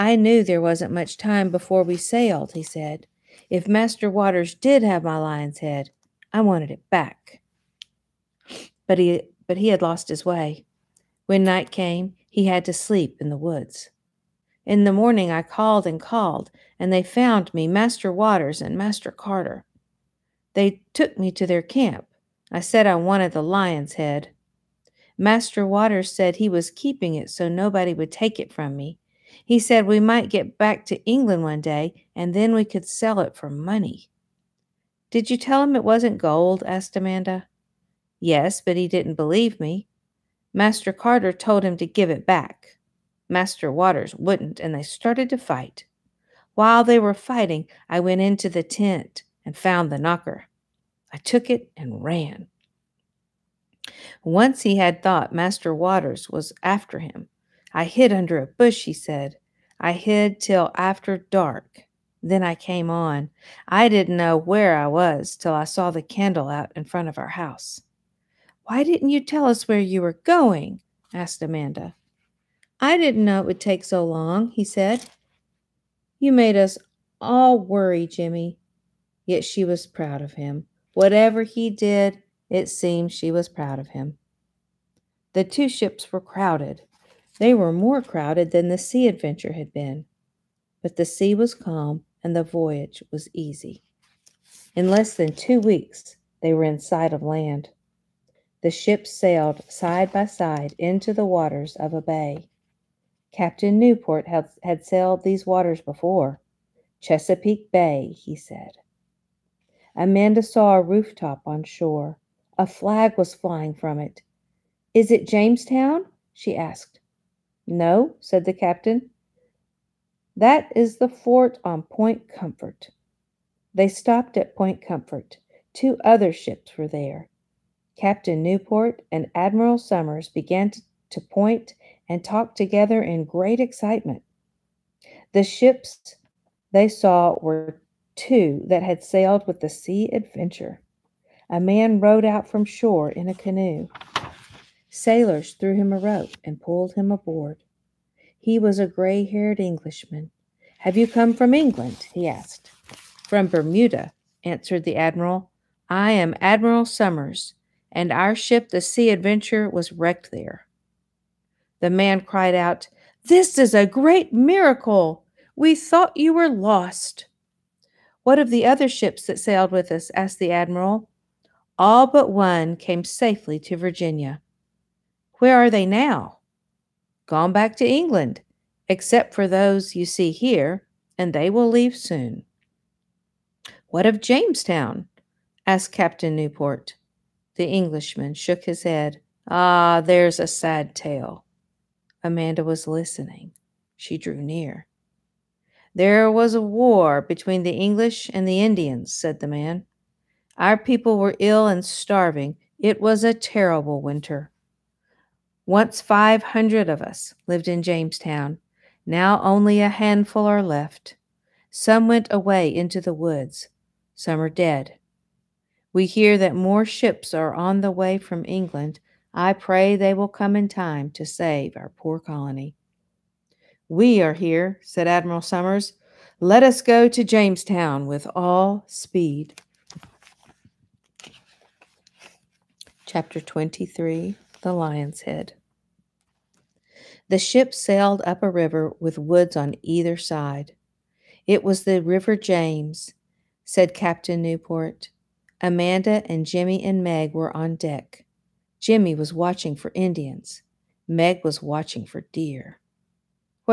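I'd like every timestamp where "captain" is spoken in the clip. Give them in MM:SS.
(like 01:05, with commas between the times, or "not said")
01:43, 01:58, 02:07, 03:05, 04:03.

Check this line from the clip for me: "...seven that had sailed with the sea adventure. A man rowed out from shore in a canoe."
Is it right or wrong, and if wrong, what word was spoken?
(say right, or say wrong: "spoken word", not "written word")
wrong: "two", not "seven".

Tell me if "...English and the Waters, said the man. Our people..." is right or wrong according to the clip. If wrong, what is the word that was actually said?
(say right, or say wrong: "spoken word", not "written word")
wrong: "Indians", not "Waters".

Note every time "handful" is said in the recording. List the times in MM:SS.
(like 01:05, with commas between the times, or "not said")
03:29.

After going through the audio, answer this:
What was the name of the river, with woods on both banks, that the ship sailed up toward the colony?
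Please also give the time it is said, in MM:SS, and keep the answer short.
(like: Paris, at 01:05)
River James, at 04:02.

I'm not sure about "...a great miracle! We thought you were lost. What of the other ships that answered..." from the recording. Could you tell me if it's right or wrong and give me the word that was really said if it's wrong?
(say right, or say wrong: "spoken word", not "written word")
wrong: "sailed", not "answered".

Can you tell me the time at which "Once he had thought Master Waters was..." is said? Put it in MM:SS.
00:54.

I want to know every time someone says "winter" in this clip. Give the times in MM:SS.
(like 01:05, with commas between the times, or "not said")
03:24.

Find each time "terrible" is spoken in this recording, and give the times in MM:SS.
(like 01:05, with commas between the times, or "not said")
03:23.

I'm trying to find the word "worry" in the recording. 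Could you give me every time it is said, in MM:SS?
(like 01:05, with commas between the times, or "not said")
01:17.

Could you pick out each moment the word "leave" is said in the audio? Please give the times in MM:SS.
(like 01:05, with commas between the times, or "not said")
03:01.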